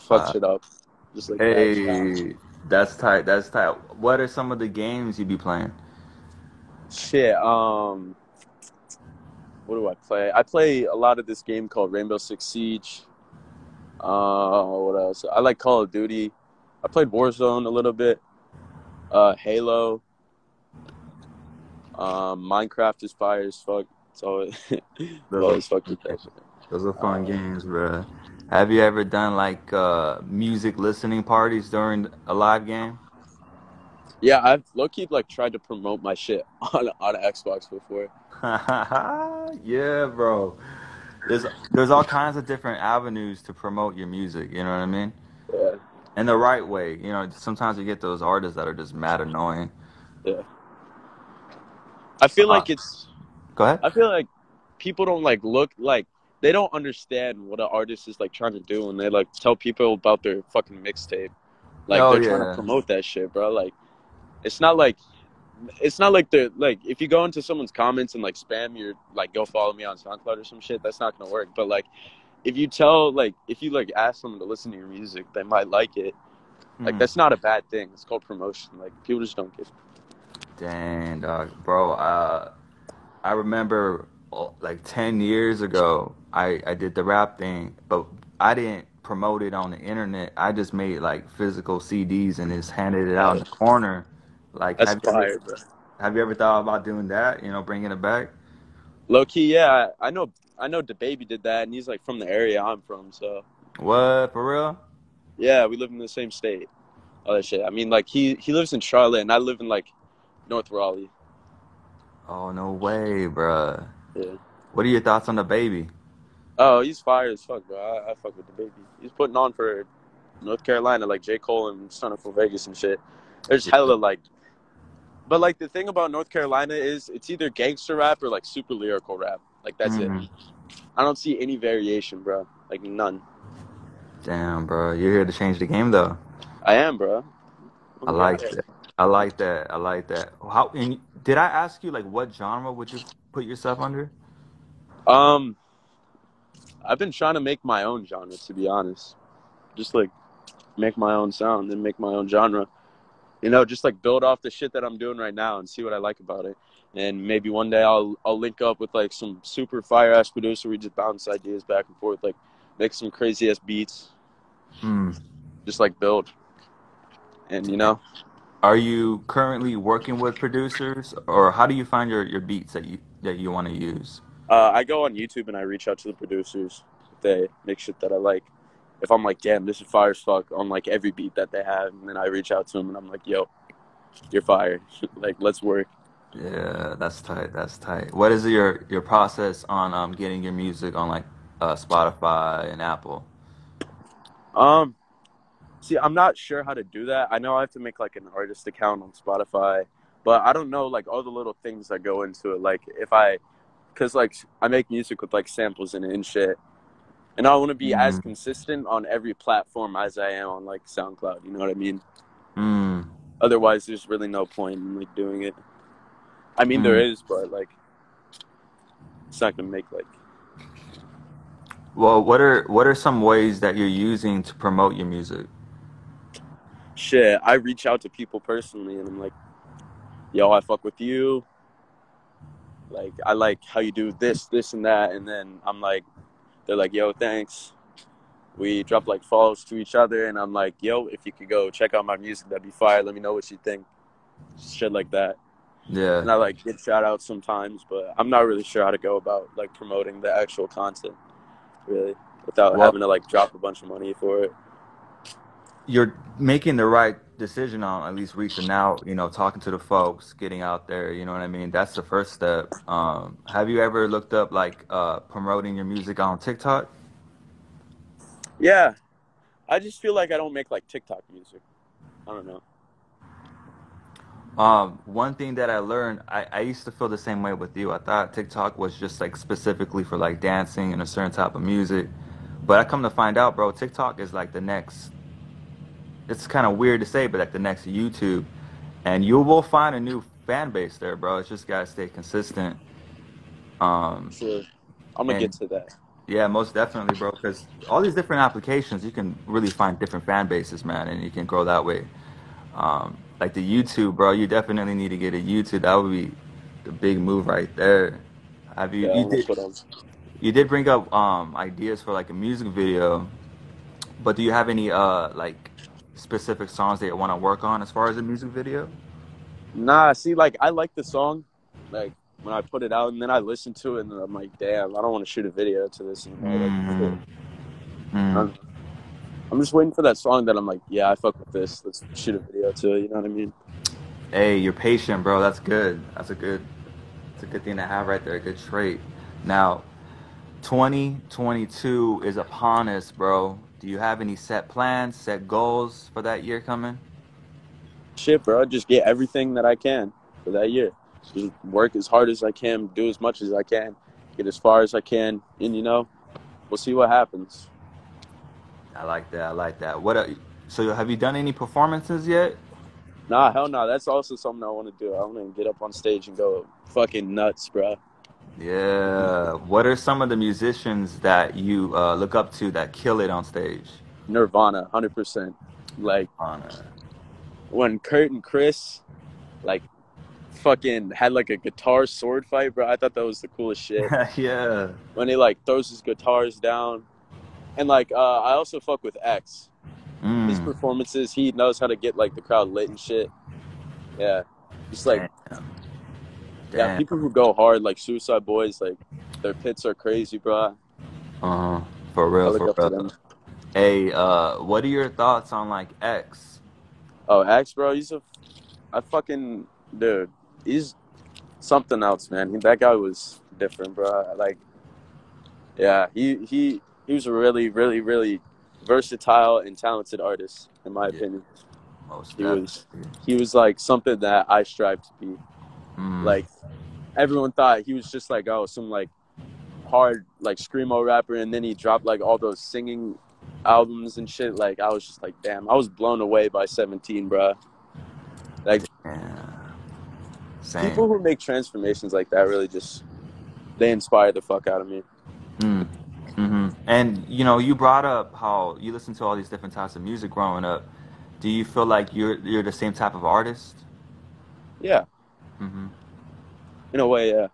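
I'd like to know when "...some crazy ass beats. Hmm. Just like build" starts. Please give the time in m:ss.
2:42.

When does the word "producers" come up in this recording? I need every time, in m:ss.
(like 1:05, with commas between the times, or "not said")
2:40, 2:50, 2:56.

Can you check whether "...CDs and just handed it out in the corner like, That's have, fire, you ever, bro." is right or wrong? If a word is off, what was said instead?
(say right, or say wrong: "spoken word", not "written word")
right.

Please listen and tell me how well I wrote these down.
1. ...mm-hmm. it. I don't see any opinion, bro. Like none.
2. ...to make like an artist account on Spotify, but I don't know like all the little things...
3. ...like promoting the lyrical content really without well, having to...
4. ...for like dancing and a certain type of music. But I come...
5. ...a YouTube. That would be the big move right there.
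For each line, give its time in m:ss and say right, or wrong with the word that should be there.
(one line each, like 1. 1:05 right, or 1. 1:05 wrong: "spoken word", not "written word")
1. 2:09 wrong: "variation", not "opinion"
2. 3:17 right
3. 4:09 wrong: "actual", not "lyrical"
4. 4:40 right
5. 5:05 right.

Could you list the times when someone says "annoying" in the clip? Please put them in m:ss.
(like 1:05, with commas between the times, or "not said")
0:49.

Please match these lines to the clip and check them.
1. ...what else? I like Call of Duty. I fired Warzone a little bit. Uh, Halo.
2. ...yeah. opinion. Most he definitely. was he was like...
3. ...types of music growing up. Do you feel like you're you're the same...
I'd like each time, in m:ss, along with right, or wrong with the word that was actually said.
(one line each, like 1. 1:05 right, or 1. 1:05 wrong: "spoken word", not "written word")
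1. 0:14 wrong: "played", not "fired"
2. 7:01 right
3. 7:29 right.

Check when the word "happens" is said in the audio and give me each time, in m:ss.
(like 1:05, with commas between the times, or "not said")
5:57.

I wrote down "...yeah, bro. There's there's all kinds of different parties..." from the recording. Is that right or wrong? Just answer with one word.
wrong.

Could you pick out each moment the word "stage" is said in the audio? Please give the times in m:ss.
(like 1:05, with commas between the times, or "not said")
6:05, 6:13.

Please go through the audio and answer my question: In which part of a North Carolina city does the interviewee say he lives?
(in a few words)
North Raleigh.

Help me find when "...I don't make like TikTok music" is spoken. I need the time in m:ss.
4:30.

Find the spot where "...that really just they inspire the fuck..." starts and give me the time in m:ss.
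7:22.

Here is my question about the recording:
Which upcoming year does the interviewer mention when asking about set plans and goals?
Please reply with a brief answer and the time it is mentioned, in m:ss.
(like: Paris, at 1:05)
2022, at 5:40.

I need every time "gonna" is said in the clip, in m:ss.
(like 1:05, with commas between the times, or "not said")
1:11, 3:39, 4:55.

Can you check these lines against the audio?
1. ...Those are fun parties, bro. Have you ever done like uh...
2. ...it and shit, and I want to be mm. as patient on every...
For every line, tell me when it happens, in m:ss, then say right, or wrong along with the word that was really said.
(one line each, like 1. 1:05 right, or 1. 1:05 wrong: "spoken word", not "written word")
1. 0:26 wrong: "games", not "parties"
2. 3:26 wrong: "consistent", not "patient".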